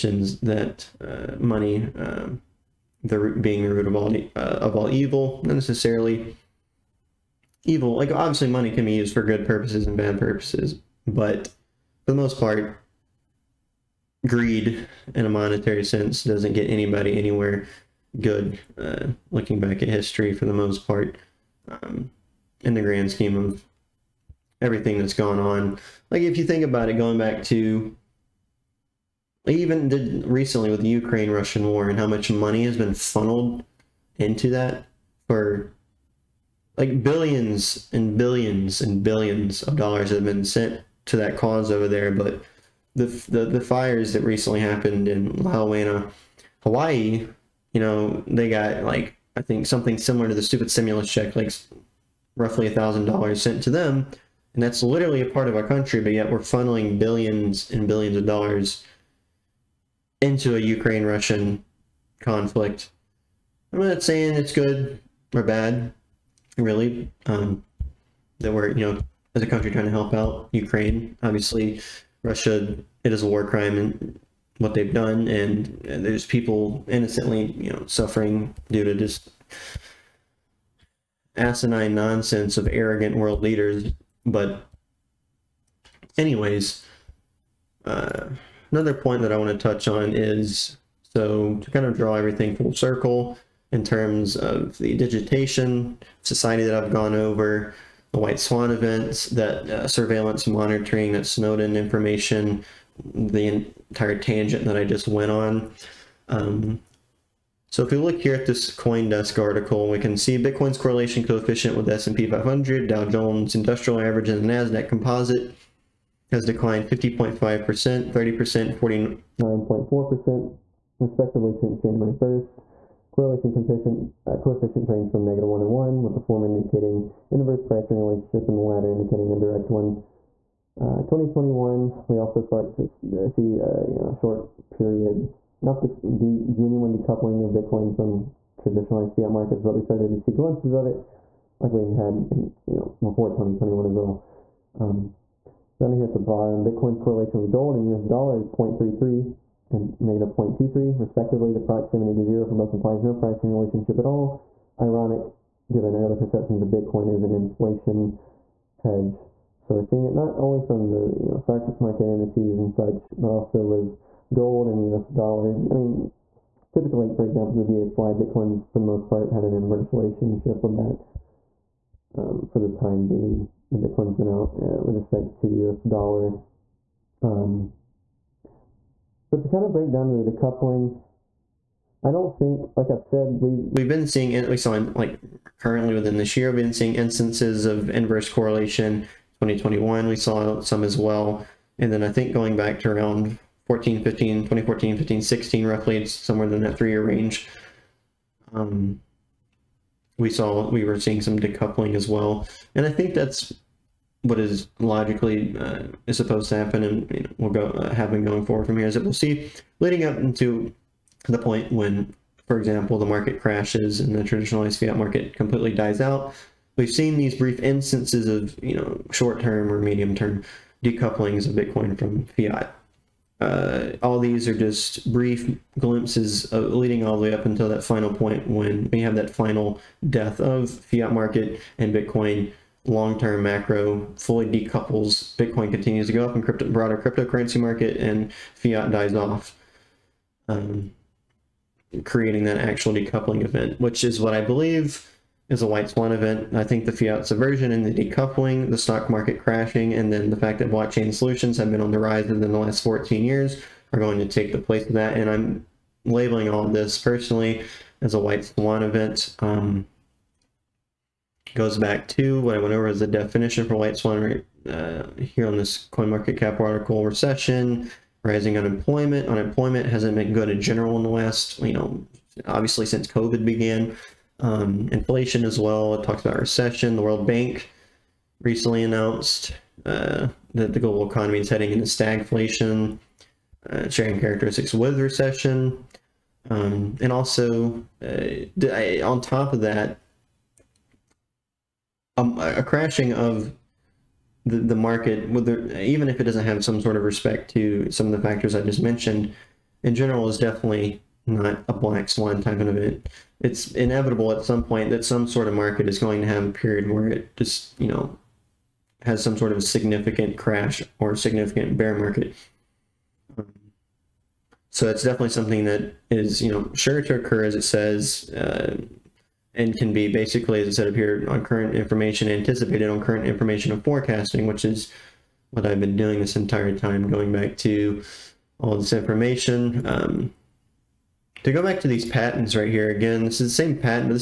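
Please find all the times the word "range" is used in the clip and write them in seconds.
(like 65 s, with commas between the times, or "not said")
124 s, 197 s.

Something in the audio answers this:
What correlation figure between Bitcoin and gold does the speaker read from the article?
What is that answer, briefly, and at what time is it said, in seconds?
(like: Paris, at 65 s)
0.33, at 148 s.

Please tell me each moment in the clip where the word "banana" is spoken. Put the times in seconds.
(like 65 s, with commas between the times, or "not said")
not said.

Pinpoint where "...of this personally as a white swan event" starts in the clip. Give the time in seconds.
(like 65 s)
256 s.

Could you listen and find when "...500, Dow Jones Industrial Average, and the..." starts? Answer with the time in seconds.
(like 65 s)
112 s.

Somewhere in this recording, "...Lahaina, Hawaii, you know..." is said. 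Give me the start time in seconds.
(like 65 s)
45 s.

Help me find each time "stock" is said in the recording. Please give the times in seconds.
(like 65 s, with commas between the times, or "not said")
161 s, 248 s.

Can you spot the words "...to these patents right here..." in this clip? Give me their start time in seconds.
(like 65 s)
331 s.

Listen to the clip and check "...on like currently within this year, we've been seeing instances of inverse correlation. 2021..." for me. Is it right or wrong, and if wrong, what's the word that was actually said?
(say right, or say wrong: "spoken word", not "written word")
right.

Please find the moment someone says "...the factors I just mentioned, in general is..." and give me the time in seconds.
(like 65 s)
298 s.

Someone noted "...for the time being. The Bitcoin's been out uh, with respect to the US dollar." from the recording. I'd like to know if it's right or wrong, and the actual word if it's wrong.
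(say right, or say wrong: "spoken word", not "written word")
right.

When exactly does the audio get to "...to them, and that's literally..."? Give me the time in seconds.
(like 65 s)
53 s.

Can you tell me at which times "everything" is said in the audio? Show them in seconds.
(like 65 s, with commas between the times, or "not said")
24 s, 92 s.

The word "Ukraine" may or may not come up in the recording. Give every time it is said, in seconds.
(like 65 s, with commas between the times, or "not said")
30 s, 60 s, 70 s.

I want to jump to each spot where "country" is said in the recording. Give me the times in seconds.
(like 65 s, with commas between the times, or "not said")
55 s, 69 s.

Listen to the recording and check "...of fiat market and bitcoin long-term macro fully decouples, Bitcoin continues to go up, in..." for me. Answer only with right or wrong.
right.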